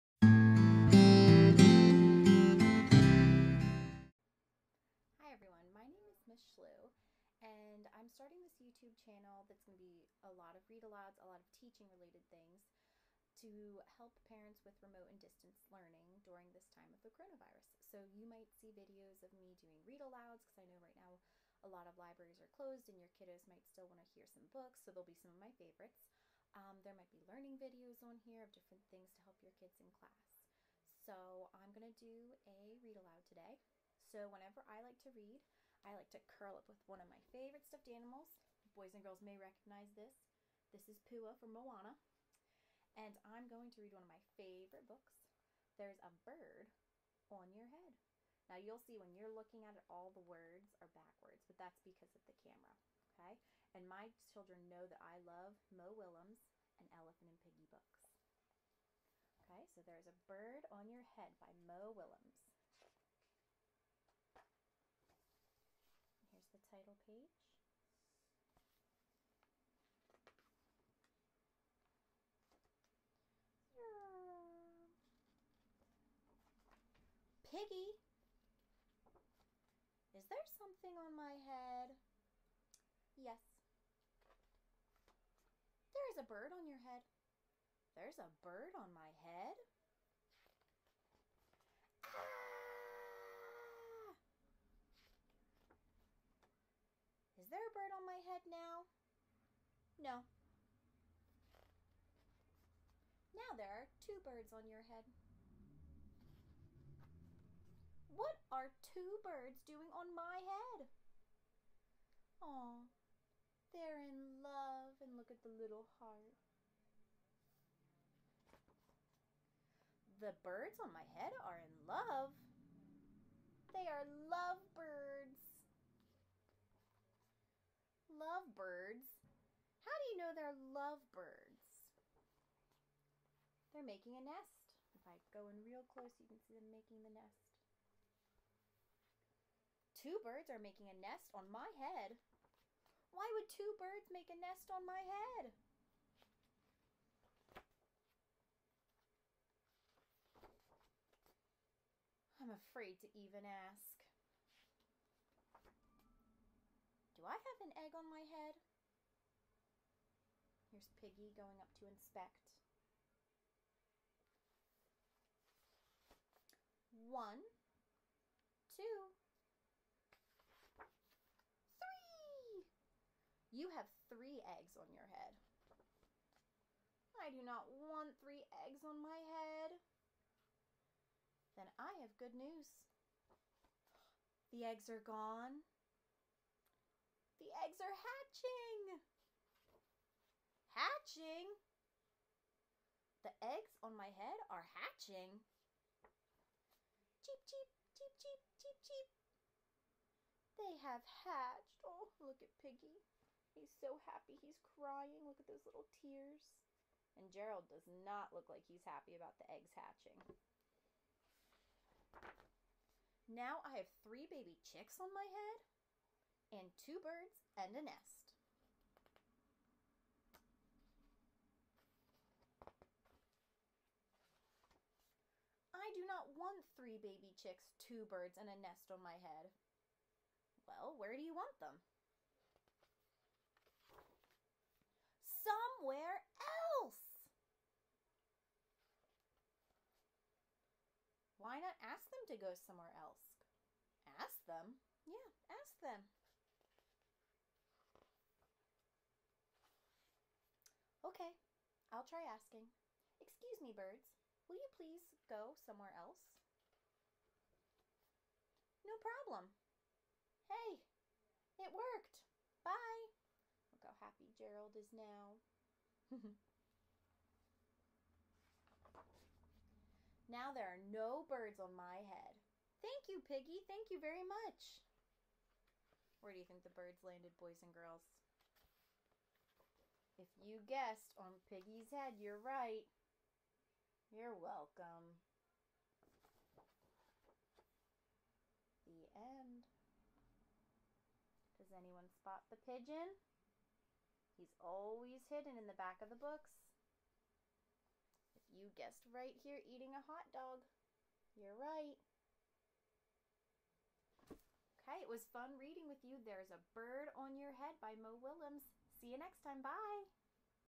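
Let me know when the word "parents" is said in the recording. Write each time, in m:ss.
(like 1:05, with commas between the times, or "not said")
0:14.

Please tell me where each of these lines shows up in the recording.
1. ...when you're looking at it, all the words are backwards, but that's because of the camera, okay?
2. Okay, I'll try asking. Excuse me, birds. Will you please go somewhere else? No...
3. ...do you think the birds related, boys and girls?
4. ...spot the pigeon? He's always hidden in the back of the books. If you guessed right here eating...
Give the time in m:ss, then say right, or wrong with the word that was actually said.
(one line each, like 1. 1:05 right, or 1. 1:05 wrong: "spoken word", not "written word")
1. 0:48 right
2. 4:11 right
3. 4:36 wrong: "landed", not "related"
4. 4:52 right.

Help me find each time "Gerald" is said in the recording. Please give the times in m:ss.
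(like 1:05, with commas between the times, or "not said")
3:27, 4:24.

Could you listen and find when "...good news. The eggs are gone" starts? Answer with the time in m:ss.
3:02.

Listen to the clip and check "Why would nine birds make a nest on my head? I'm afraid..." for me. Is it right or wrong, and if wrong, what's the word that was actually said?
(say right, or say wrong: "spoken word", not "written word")
wrong: "two", not "nine".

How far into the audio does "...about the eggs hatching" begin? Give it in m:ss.
3:29.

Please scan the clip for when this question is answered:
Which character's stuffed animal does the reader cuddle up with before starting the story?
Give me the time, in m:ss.
0:41.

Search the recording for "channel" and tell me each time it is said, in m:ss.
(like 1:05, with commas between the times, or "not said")
0:09.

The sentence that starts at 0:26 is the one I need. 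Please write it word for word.
Um, there might be learning videos on here of different things to help your kids in class.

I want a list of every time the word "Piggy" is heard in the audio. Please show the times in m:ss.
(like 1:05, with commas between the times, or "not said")
0:57, 1:17, 2:40, 3:22, 4:33, 4:41.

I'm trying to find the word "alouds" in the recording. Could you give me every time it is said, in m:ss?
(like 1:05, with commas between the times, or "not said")
0:10, 0:20, 0:33.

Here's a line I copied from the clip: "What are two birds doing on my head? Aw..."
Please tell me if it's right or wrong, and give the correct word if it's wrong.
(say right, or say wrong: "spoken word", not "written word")
right.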